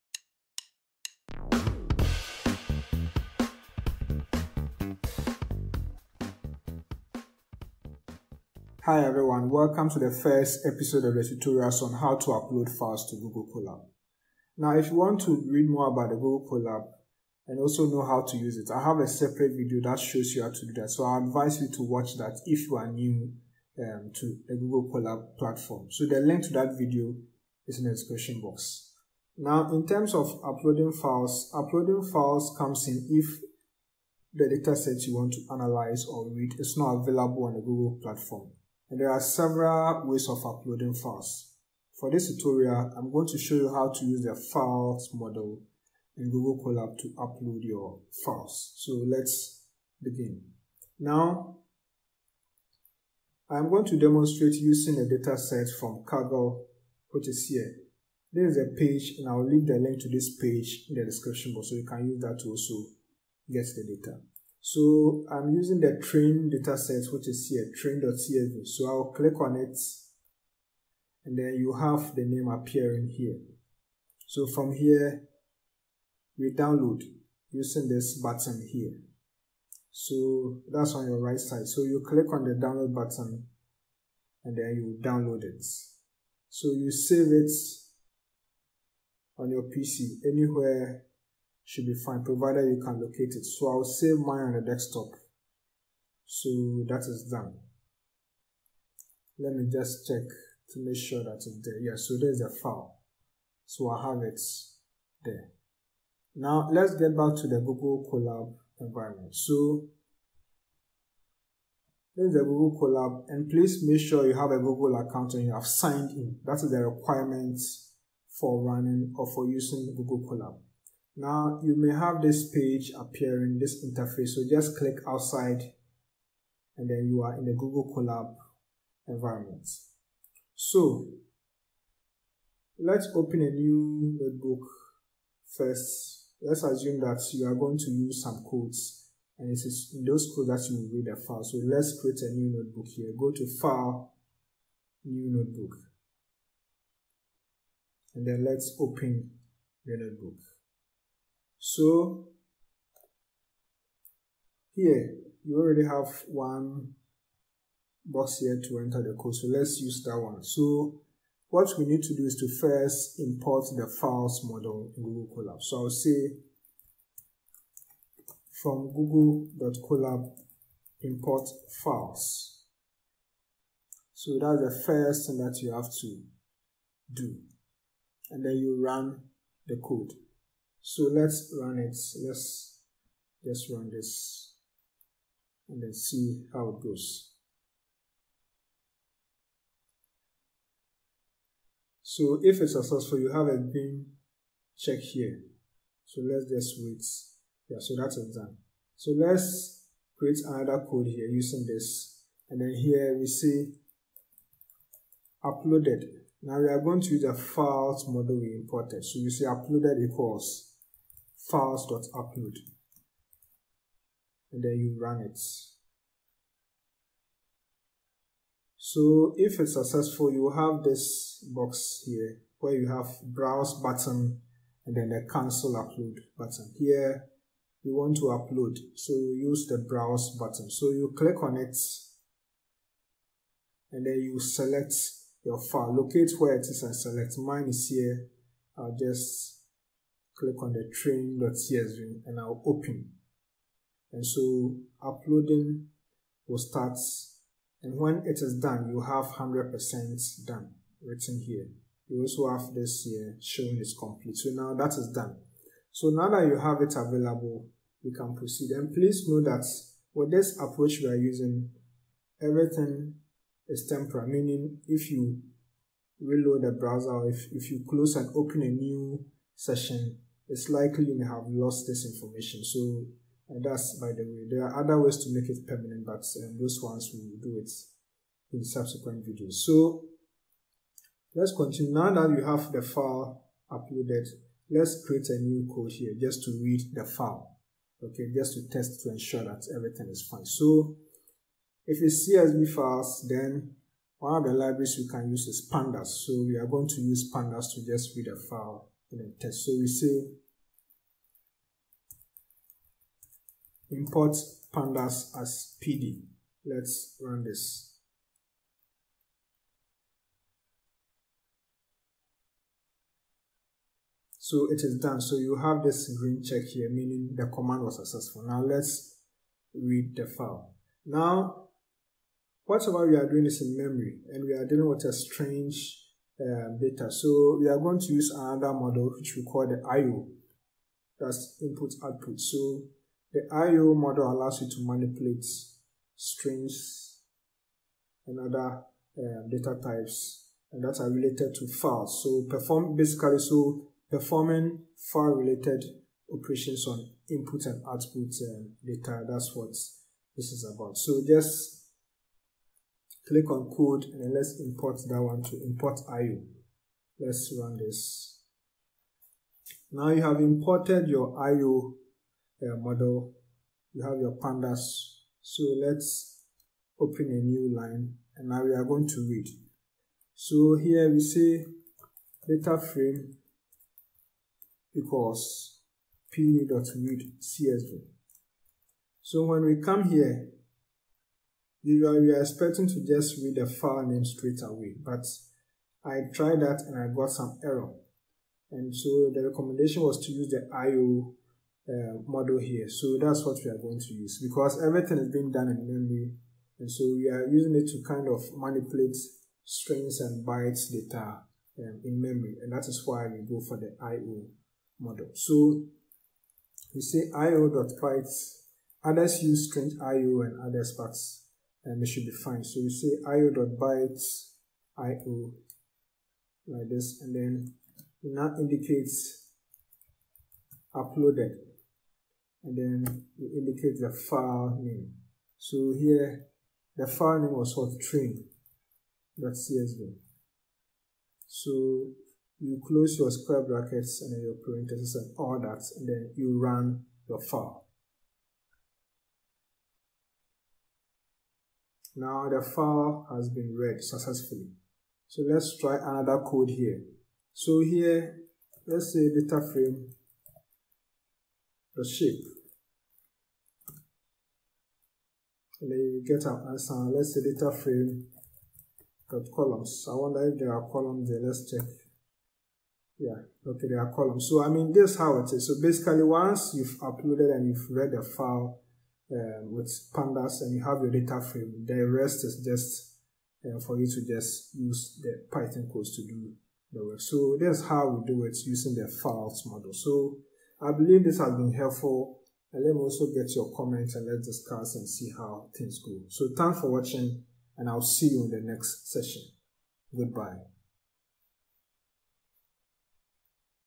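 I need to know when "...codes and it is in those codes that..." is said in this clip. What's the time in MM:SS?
02:18.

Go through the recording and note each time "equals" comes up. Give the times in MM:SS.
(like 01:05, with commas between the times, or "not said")
03:30, 06:14.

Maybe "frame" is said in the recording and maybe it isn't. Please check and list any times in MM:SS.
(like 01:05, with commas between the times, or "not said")
06:12, 07:29, 07:37, 07:51.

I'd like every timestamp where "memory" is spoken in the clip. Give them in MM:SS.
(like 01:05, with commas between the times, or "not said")
05:23, 06:35, 06:42.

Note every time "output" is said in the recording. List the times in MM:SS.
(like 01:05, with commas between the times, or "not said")
05:32, 05:47.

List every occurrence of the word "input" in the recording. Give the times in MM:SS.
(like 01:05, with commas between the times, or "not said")
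05:31, 05:47.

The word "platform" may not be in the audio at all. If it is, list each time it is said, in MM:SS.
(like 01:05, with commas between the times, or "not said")
00:25, 00:38.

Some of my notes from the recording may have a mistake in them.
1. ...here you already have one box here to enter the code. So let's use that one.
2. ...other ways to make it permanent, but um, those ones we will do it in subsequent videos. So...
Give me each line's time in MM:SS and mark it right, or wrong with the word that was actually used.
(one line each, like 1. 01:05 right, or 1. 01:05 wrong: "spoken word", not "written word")
1. 02:34 right
2. 04:34 right.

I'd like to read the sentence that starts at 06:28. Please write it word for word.
And so the recommendation was to use the IO uh, module here.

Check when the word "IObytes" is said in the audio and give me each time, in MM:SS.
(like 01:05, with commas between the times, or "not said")
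06:47, 06:53.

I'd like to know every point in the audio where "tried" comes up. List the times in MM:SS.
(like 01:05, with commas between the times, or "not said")
06:26.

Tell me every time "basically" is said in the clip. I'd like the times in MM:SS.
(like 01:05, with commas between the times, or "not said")
05:42, 07:45.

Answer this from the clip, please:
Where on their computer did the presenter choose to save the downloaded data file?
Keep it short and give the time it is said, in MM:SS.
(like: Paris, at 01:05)
desktop, at 01:34.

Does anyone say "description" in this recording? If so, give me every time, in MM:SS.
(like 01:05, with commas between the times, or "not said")
00:27, 01:01.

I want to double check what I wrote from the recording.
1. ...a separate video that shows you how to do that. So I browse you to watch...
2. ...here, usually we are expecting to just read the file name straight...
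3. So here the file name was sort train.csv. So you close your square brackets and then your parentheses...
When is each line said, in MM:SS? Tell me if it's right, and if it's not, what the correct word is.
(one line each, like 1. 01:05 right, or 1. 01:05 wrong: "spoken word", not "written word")
1. 00:18 wrong: "advise", not "browse"
2. 06:20 right
3. 07:05 right.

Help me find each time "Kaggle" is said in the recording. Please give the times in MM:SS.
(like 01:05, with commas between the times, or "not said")
00:56.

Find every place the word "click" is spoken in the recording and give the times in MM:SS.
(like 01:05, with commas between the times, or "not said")
01:09, 01:22, 02:04, 03:51, 04:00, 05:53.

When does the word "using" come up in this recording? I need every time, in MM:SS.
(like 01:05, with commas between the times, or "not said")
00:54, 01:05, 01:17, 01:59, 03:21, 04:21, 06:37, 07:58.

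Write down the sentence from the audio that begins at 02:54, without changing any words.
So that's the first thing that you have to do.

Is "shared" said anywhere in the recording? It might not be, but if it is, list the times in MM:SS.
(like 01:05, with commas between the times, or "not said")
not said.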